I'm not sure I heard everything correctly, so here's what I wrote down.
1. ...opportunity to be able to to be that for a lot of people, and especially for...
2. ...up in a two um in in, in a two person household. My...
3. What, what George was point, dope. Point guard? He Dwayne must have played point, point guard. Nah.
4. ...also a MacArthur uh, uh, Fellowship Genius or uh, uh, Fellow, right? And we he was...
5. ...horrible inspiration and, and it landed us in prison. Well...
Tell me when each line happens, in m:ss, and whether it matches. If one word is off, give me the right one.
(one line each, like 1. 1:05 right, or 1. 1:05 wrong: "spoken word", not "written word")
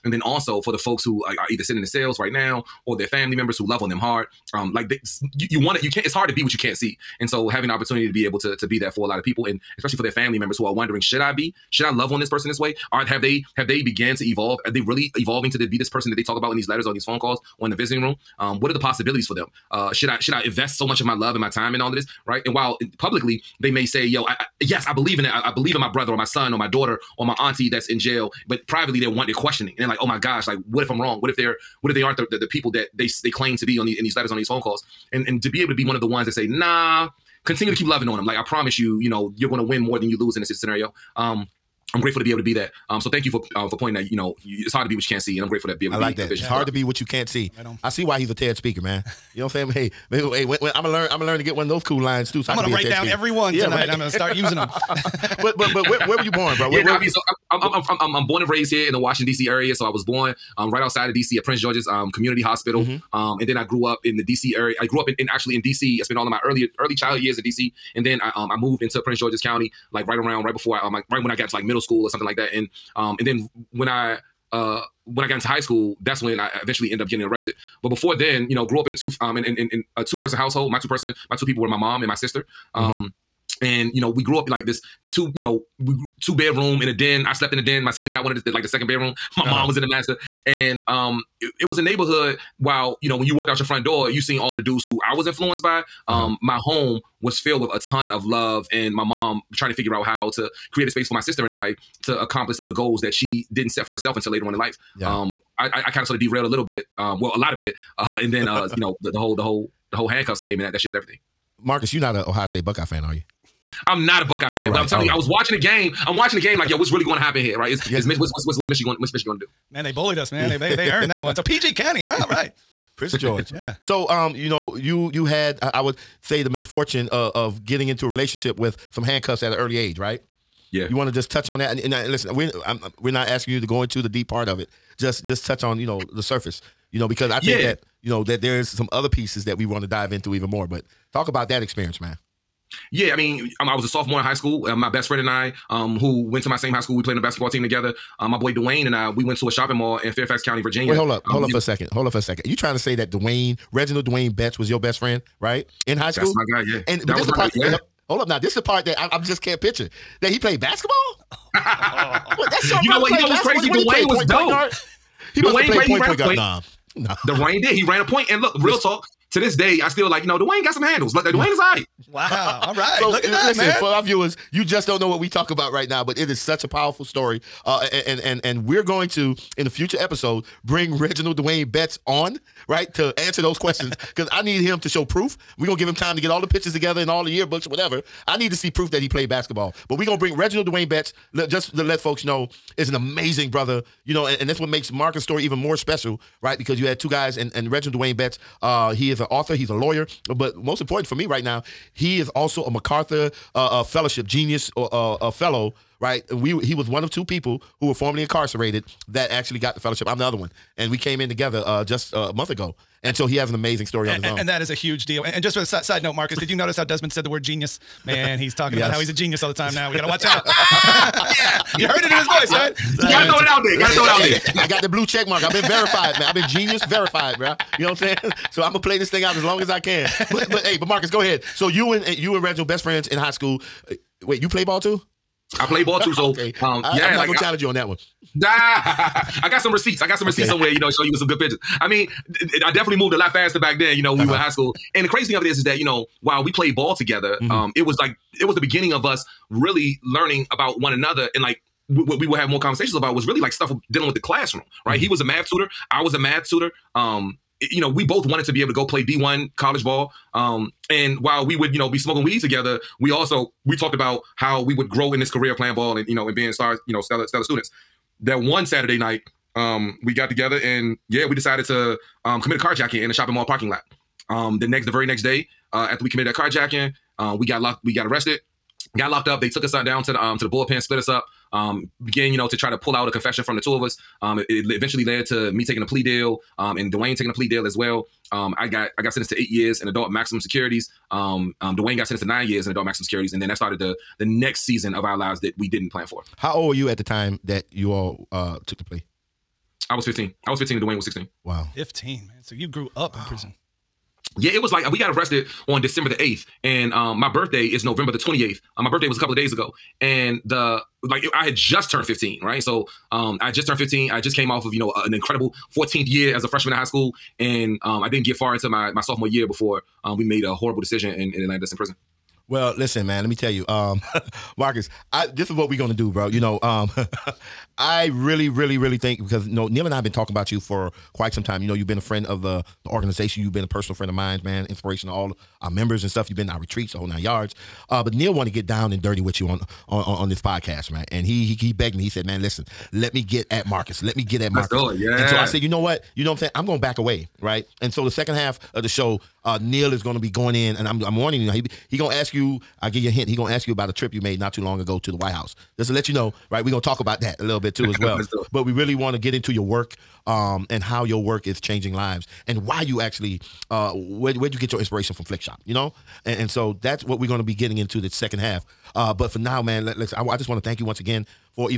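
1. 0:07 right
2. 1:18 right
3. 2:43 wrong: "Dwayne", not "George"
4. 3:22 right
5. 5:20 wrong: "decision", not "inspiration".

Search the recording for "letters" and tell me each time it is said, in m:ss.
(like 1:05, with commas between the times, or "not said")
0:16, 0:34.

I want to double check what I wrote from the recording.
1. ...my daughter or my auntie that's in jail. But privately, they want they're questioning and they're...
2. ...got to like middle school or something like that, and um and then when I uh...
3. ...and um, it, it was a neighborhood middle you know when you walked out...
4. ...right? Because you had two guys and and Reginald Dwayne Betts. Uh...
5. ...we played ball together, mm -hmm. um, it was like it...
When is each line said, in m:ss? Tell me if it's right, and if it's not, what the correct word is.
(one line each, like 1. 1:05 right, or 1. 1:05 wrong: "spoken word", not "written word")
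1. 0:26 right
2. 1:11 right
3. 1:30 wrong: "while", not "middle"
4. 3:16 right
5. 4:06 right.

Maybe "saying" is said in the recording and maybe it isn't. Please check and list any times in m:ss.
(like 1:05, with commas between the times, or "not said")
0:49, 3:47, 5:46.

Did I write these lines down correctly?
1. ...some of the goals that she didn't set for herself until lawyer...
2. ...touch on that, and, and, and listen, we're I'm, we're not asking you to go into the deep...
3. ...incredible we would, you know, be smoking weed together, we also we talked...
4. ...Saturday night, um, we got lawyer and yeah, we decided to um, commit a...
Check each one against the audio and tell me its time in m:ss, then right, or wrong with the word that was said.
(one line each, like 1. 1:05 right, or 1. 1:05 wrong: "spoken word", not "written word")
1. 1:42 wrong: "later", not "lawyer"
2. 2:11 right
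3. 4:21 wrong: "while", not "incredible"
4. 4:28 wrong: "together", not "lawyer".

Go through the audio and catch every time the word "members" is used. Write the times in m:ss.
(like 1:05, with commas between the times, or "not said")
0:03, 0:10, 5:35.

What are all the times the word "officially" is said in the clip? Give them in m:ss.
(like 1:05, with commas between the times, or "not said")
not said.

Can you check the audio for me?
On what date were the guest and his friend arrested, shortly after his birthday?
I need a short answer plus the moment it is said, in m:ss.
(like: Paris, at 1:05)
December 8, at 5:05.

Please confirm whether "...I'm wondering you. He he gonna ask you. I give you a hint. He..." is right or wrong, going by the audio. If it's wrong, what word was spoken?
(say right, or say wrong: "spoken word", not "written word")
wrong: "warning", not "wondering".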